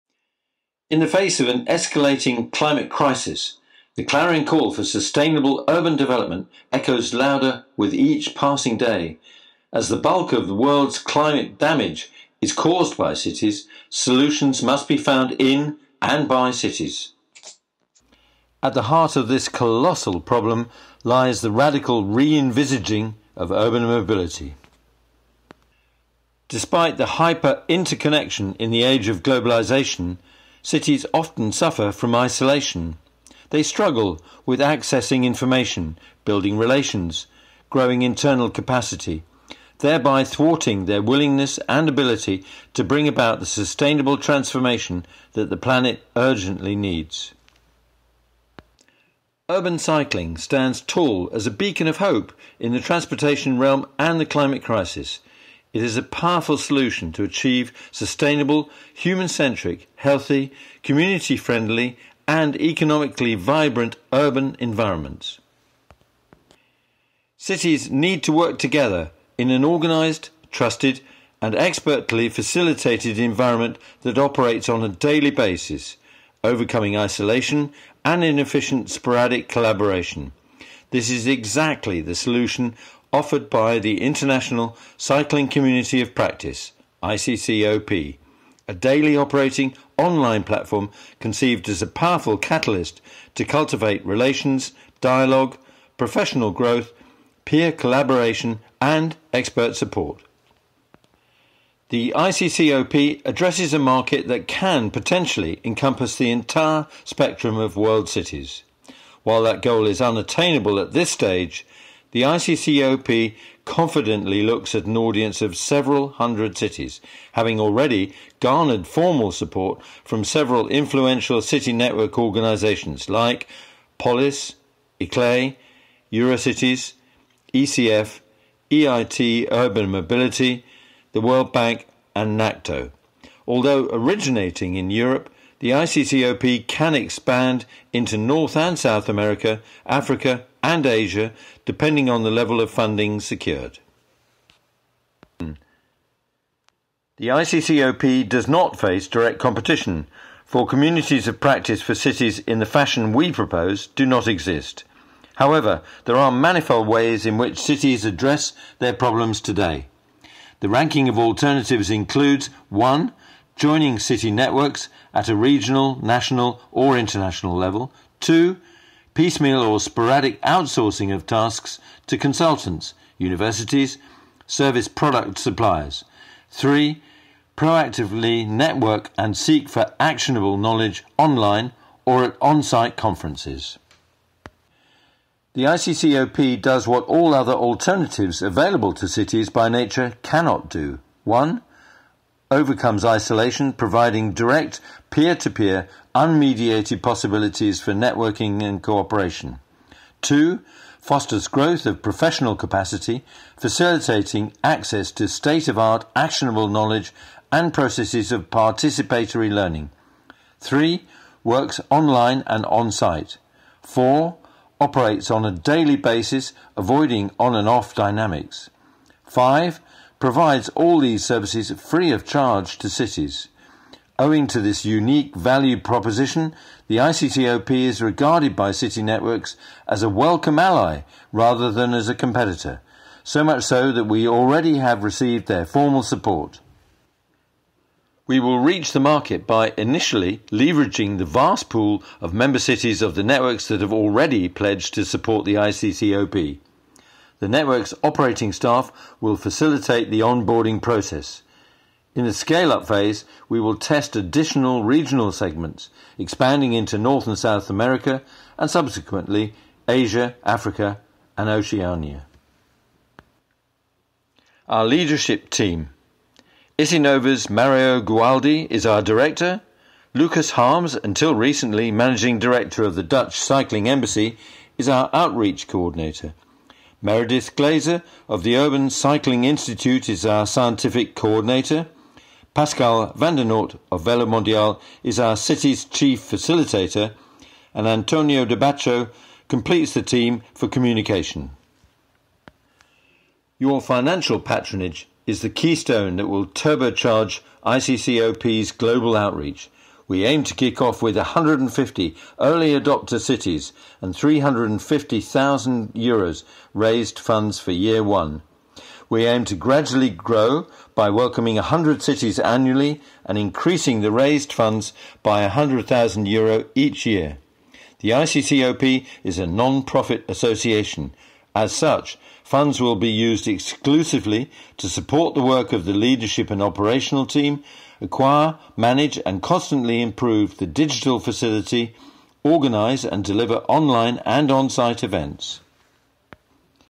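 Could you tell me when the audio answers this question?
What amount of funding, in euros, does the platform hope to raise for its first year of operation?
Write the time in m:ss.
5:04.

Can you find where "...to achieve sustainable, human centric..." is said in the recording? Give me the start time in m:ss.
0:57.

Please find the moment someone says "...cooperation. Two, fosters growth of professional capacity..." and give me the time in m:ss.
3:18.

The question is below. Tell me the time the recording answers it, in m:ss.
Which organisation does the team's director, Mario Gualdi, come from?
4:26.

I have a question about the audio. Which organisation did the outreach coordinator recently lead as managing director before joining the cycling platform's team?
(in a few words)
Dutch Cycling Embassy.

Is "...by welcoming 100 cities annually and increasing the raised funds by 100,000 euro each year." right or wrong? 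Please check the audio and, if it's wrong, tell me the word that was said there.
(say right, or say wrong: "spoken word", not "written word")
right.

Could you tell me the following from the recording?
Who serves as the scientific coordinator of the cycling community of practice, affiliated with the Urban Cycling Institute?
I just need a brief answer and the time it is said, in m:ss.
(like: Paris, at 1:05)
Meredith Glaser, at 4:37.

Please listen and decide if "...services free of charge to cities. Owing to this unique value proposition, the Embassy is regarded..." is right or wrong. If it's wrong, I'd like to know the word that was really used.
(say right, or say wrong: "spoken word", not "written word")
wrong: "ICCOP", not "Embassy".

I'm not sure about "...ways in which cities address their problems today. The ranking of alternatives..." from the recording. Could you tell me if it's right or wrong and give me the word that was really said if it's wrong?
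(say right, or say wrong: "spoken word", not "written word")
right.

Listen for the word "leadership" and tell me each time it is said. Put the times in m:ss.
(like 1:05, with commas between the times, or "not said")
4:24, 5:25.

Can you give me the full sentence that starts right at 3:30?
Three, works online and on site.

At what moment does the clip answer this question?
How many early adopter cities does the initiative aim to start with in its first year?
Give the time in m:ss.
5:01.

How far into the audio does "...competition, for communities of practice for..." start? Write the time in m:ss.
2:29.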